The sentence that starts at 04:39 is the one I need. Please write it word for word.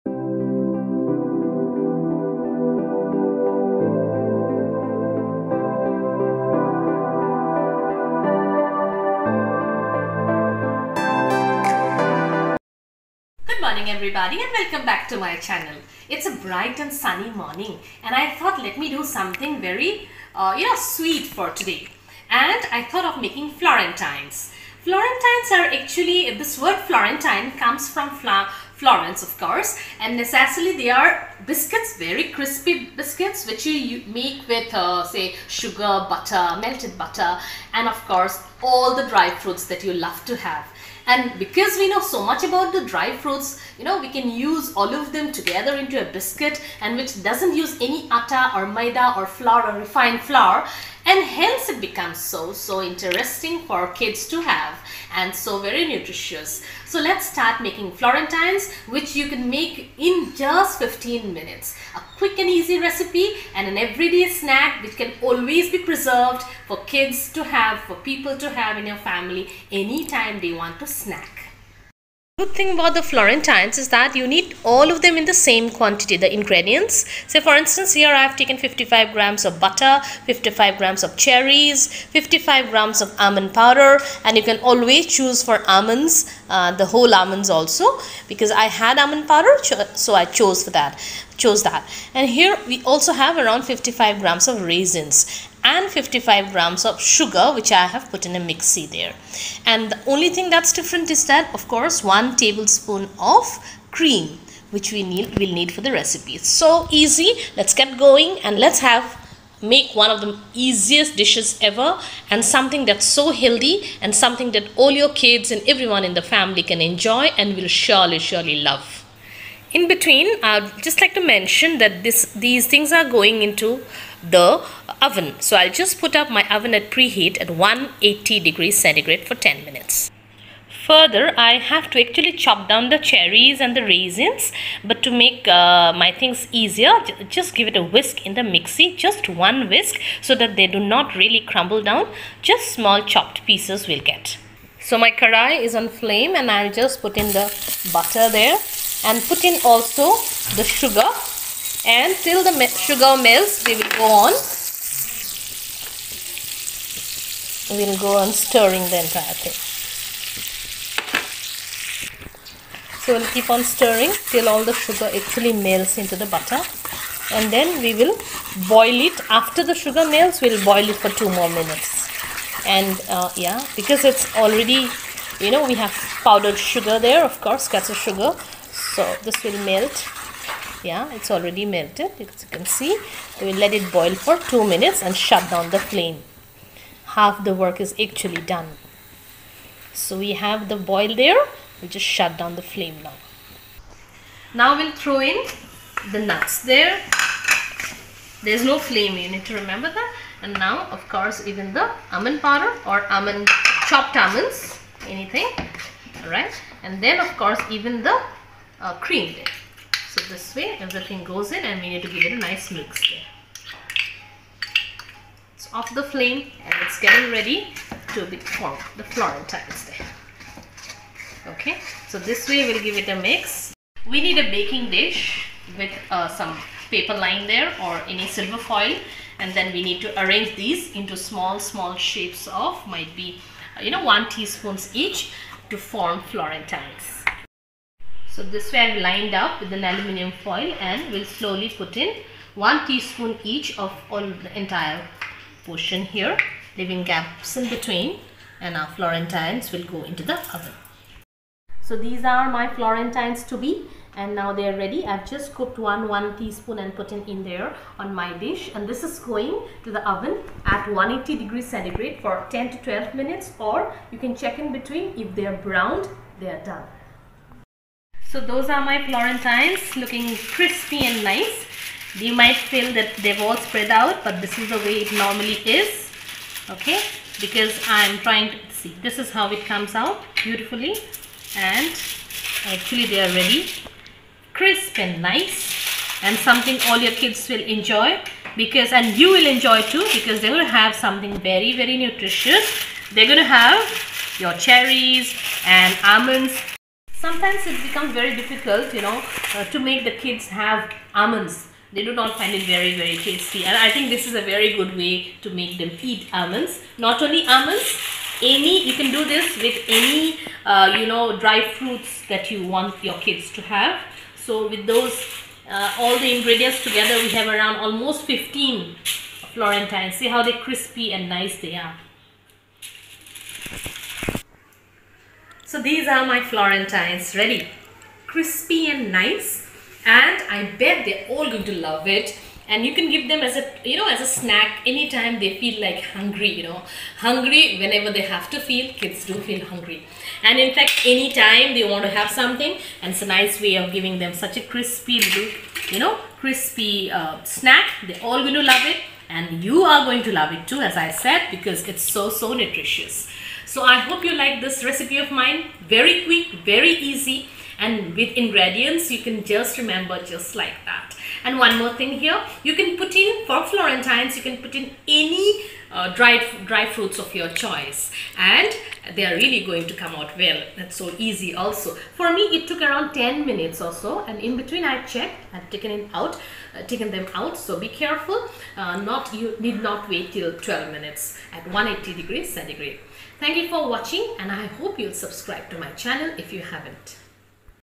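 This is how it comes out beautifully and actually they are ready.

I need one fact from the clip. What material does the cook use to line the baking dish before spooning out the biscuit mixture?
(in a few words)
aluminium foil.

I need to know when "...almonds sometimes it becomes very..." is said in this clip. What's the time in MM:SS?
04:56.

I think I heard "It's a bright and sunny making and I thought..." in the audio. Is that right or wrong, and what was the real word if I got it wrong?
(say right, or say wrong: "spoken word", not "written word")
wrong: "morning", not "making".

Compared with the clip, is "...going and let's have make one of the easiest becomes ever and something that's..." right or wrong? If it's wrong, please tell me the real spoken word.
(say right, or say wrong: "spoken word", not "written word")
wrong: "dishes", not "becomes".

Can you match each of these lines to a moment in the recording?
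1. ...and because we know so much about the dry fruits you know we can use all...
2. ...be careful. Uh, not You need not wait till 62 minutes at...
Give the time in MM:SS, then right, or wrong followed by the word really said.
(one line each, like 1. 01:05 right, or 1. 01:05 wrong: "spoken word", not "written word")
1. 00:41 right
2. 06:17 wrong: "12", not "62".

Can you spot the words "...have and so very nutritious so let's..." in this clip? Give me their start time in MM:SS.
00:54.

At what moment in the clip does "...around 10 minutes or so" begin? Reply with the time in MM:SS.
06:12.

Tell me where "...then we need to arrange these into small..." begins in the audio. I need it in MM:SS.
03:49.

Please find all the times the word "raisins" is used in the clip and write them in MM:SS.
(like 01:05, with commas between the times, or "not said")
01:34, 02:13.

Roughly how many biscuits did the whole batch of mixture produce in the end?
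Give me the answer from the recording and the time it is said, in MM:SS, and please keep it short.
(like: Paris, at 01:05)
15, at 05:17.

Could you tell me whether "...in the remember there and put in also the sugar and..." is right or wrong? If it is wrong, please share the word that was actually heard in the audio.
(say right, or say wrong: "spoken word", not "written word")
wrong: "butter", not "remember".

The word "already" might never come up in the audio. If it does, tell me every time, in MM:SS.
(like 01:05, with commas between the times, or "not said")
02:54, 03:01.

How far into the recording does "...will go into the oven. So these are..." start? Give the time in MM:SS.
04:09.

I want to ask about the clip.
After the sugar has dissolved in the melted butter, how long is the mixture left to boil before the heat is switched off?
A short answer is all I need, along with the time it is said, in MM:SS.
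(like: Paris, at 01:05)
two minutes, at 02:51.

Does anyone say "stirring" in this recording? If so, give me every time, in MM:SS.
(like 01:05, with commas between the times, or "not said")
02:38, 02:43.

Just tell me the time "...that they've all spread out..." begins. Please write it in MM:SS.
04:32.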